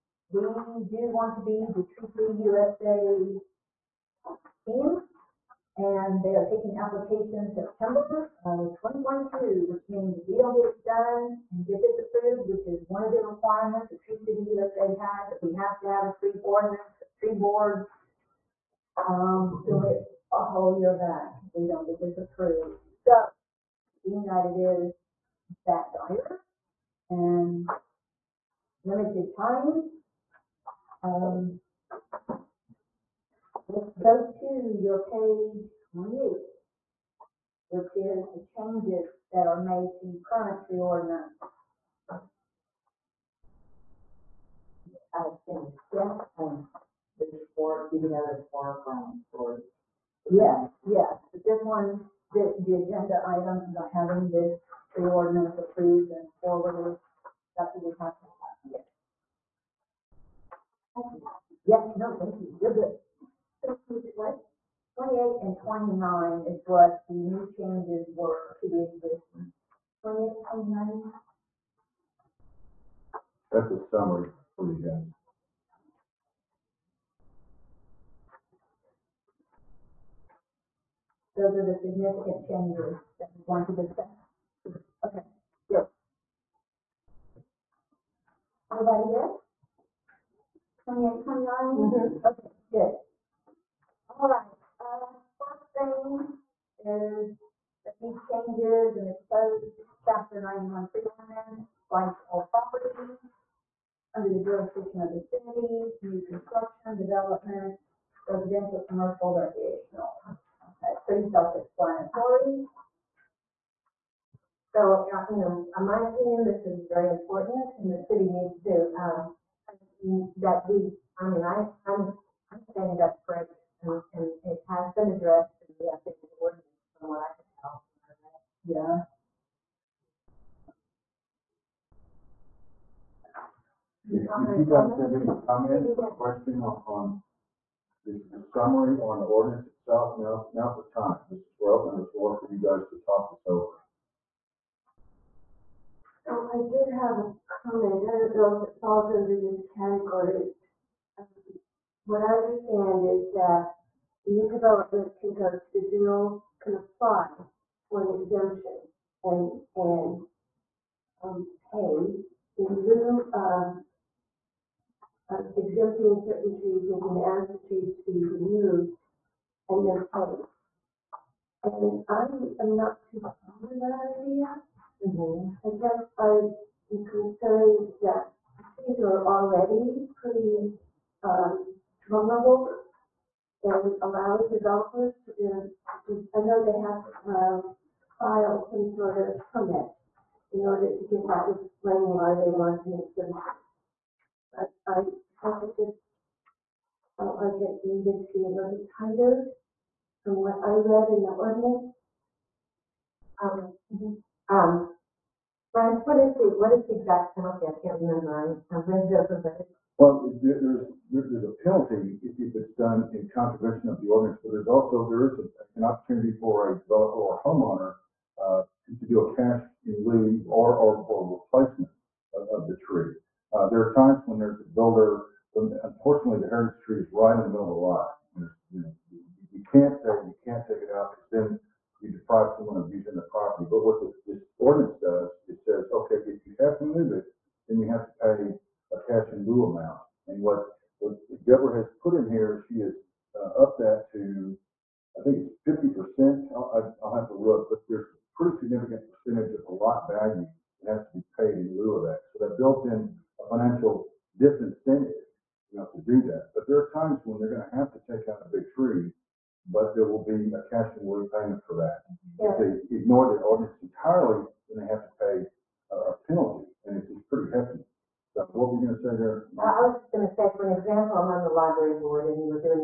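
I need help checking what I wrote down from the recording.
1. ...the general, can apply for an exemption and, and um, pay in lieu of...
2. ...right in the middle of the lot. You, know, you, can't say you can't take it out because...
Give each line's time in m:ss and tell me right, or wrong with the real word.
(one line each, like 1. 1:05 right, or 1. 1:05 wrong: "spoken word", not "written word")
1. 2:35 right
2. 3:47 right.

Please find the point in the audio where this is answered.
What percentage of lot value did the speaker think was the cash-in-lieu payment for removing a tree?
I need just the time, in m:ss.
4:05.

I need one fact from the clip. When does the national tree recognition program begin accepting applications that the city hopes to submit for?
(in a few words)
September 2022.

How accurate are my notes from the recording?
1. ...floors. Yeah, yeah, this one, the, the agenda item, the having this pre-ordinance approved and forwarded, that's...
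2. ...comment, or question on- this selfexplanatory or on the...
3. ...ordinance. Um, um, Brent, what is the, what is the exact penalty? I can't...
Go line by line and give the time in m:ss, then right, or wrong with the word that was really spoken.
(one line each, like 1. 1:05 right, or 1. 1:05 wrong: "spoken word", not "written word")
1. 0:49 right
2. 2:15 wrong: "summary", not "selfexplanatory"
3. 3:21 right.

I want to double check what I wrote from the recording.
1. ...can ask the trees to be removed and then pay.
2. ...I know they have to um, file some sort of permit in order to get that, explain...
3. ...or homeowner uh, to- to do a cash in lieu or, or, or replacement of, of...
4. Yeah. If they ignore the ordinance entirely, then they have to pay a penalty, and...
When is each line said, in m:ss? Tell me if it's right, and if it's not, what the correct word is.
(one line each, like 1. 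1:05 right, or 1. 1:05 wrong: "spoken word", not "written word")
1. 2:46 right
2. 3:06 right
3. 3:37 right
4. 4:22 right.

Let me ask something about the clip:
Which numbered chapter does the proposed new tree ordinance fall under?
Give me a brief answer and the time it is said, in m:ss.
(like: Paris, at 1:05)
Chapter 91, at 1:40.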